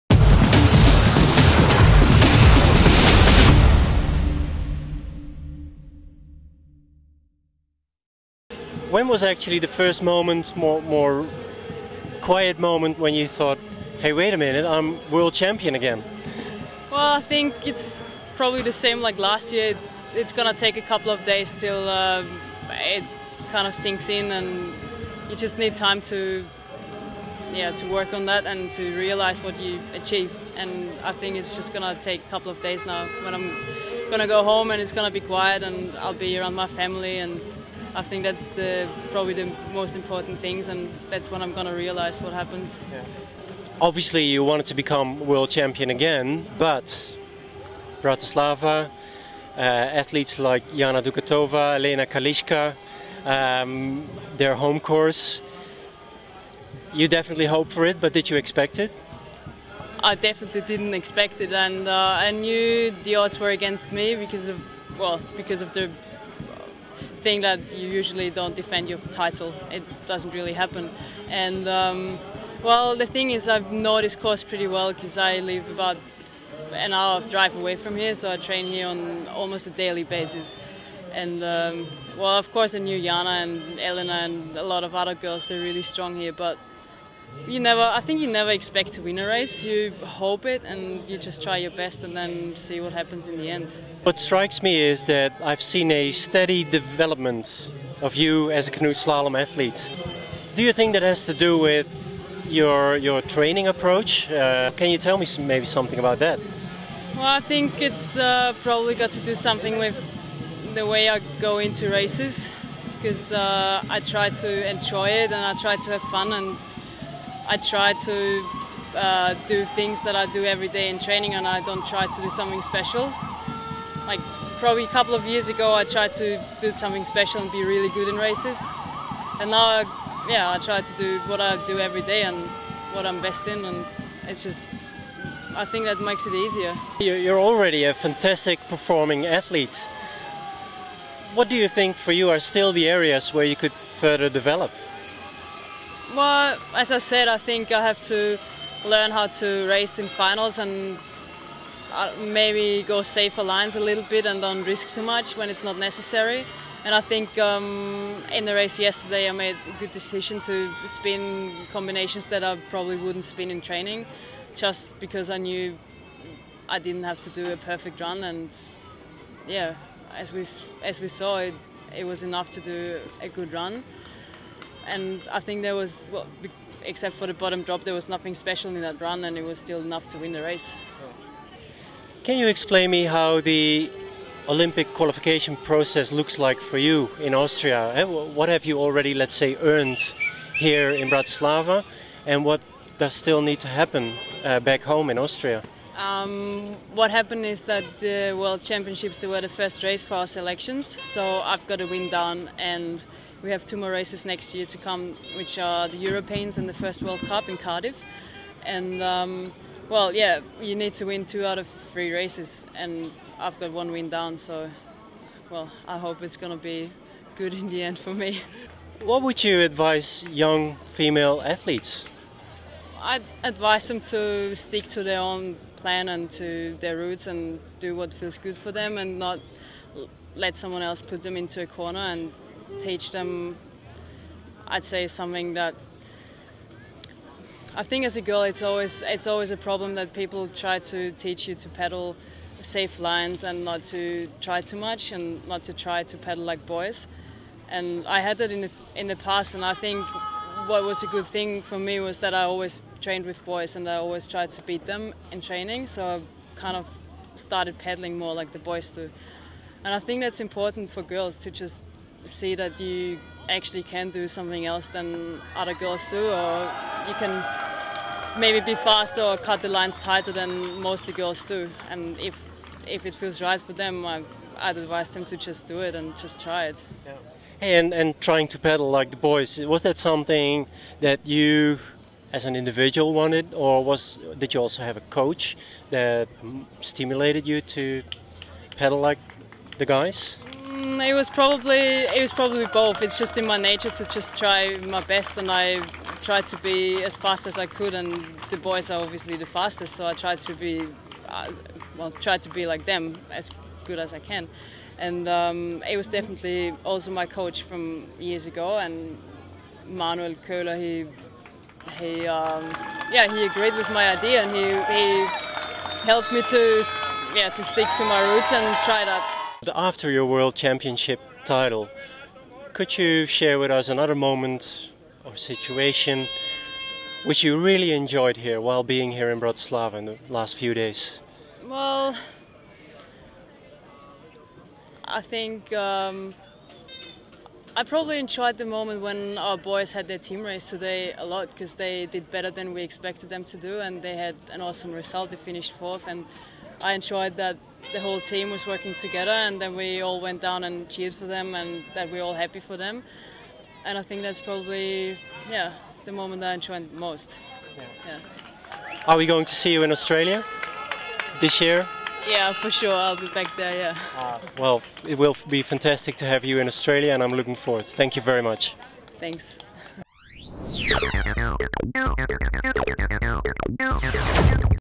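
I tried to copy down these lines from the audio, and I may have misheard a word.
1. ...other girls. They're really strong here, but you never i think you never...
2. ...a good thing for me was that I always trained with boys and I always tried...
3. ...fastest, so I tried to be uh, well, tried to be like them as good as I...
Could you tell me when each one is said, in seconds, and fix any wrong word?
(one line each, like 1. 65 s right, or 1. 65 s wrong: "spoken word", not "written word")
1. 84 s right
2. 251 s right
3. 299 s right.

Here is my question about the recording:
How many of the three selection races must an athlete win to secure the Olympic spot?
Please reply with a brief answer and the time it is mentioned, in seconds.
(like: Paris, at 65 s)
2, at 211 s.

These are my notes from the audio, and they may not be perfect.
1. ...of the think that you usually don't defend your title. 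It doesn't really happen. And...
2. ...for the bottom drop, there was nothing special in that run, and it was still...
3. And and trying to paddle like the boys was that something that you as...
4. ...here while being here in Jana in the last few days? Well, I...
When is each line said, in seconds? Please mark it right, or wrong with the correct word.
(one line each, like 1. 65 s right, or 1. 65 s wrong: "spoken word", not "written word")
1. 65 s right
2. 177 s right
3. 277 s right
4. 328 s wrong: "Bratislava", not "Jana".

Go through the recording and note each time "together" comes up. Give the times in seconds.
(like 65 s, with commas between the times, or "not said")
348 s.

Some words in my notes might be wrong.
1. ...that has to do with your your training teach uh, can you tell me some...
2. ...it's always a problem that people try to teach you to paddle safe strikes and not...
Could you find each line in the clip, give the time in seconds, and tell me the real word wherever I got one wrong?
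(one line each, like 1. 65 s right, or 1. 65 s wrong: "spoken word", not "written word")
1. 100 s wrong: "approach", not "teach"
2. 239 s wrong: "lines", not "strikes".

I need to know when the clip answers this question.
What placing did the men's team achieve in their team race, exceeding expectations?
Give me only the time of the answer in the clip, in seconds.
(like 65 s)
345 s.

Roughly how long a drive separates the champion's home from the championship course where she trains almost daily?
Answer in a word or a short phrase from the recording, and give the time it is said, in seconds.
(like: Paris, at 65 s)
About an hour, at 75 s.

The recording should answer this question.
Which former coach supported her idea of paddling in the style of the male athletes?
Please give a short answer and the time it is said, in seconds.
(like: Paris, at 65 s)
Manuel Köhler, at 309 s.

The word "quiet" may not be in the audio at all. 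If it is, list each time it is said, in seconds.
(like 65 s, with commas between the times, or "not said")
12 s, 35 s.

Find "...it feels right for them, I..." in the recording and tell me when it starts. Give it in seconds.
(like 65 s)
273 s.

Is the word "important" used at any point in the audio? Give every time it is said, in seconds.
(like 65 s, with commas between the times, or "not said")
39 s, 260 s.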